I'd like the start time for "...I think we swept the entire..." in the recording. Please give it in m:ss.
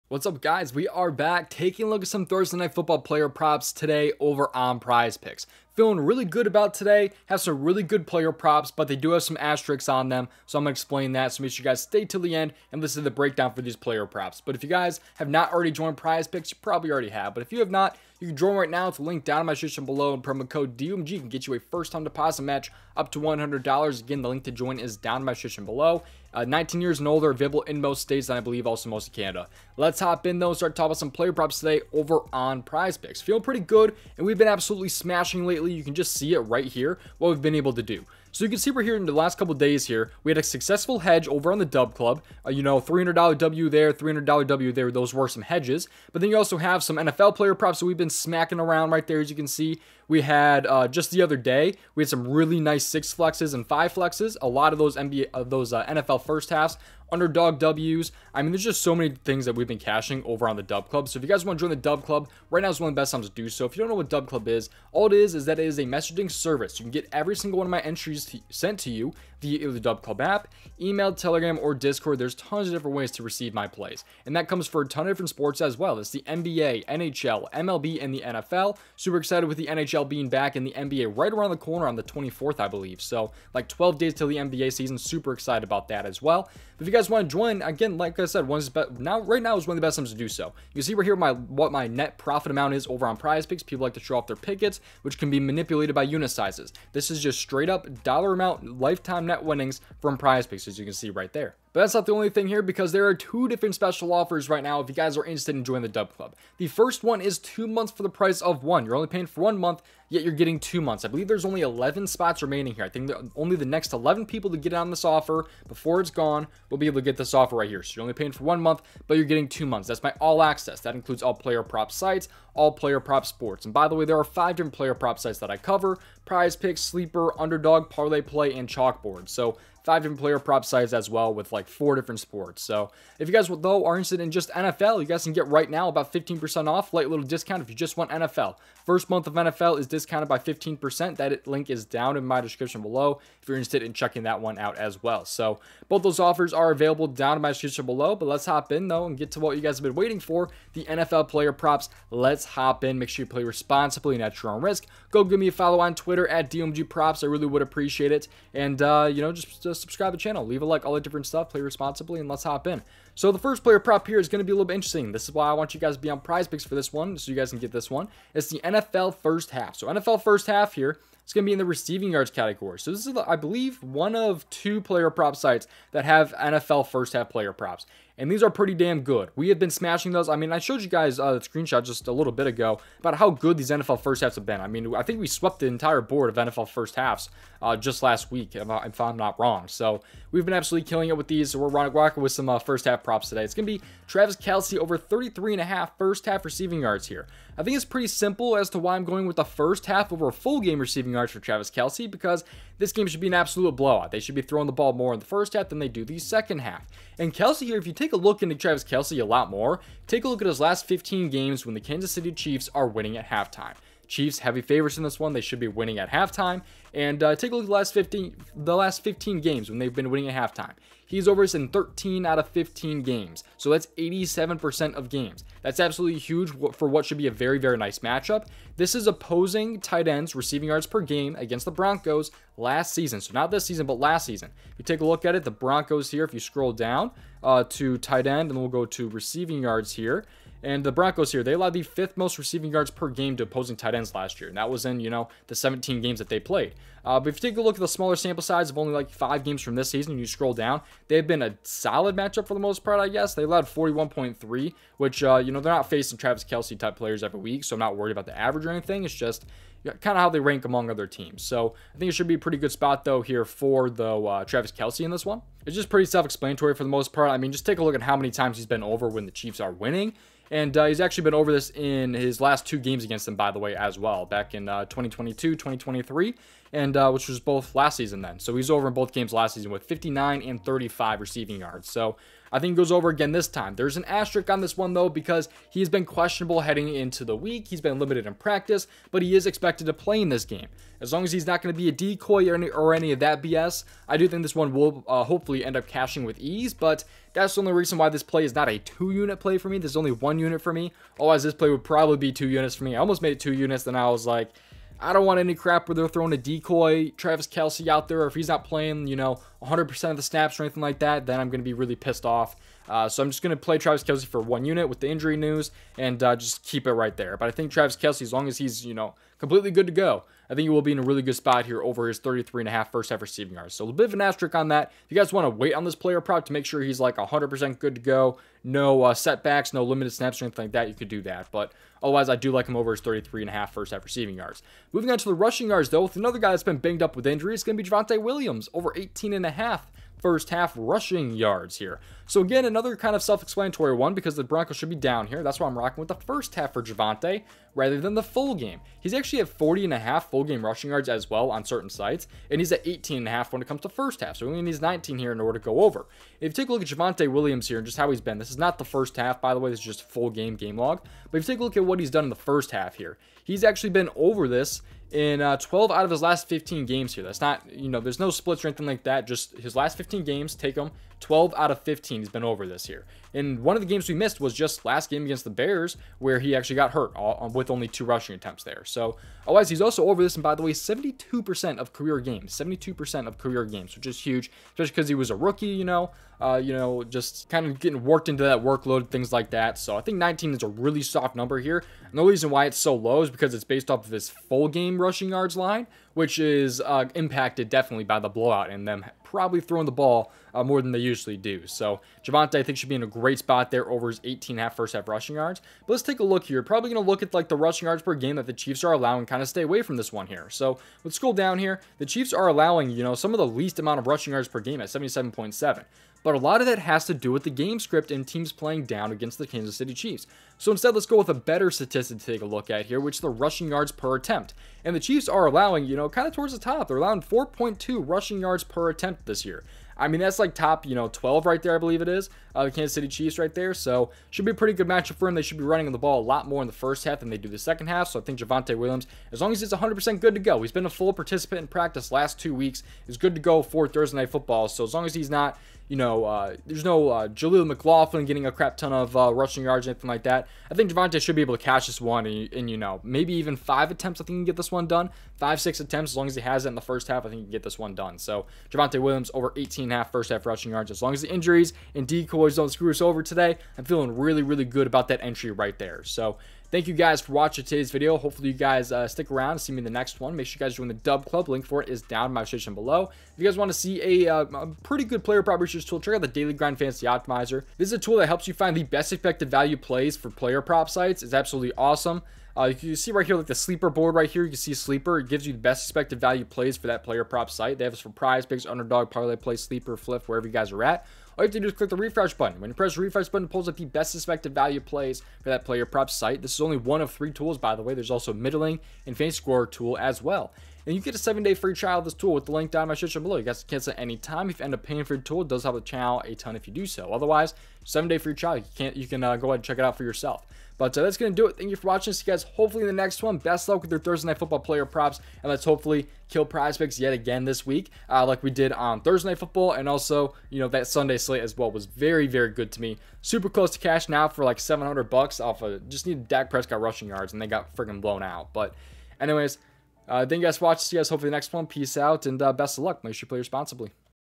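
3:04.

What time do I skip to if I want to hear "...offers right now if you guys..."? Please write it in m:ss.
1:44.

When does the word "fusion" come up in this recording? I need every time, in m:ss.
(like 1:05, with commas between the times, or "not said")
not said.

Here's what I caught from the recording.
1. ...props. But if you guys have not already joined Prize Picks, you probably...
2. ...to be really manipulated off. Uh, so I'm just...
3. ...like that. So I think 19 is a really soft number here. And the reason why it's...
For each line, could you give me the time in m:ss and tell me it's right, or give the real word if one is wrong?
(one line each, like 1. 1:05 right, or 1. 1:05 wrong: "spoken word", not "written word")
1. 0:14 right
2. 5:11 wrong: "pissed", not "manipulated"
3. 6:29 right.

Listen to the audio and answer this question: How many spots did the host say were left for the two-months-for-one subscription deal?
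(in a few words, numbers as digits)
11.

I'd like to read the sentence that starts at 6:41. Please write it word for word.
So Javonte, I think, should be in a great spot there over his 18 half first half rushing yards.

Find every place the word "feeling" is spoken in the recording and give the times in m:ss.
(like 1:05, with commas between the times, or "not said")
0:05, 0:33, 7:43.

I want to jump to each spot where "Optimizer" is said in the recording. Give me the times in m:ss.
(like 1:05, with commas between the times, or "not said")
7:57.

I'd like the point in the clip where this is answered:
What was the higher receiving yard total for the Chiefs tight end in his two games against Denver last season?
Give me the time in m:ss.
4:39.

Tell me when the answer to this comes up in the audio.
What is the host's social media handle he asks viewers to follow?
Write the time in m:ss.
2:36.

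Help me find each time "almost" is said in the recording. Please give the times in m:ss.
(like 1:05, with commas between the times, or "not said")
5:02.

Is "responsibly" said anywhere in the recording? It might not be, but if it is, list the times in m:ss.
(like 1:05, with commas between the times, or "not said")
2:33, 2:41, 8:53.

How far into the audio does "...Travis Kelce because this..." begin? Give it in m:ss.
3:21.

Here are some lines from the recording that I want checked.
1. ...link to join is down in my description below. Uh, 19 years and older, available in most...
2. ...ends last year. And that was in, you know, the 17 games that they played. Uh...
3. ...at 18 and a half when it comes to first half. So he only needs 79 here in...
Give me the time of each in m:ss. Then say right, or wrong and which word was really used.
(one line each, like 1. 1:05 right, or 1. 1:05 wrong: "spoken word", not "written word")
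1. 0:24 right
2. 4:03 right
3. 5:52 wrong: "19", not "79".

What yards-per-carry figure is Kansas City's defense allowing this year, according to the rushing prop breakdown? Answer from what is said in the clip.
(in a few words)
4.2.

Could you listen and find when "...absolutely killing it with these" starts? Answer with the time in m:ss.
3:10.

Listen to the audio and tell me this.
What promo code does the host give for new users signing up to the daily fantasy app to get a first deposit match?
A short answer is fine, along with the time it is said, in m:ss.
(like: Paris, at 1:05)
DOMG, at 0:20.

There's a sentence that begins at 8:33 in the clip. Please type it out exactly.
Best luck with your Thursday Night Football player props.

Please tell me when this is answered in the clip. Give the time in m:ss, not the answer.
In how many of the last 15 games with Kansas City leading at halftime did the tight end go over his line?
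3:41.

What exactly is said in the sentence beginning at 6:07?
That's not, you know, there's no splits or anything like that.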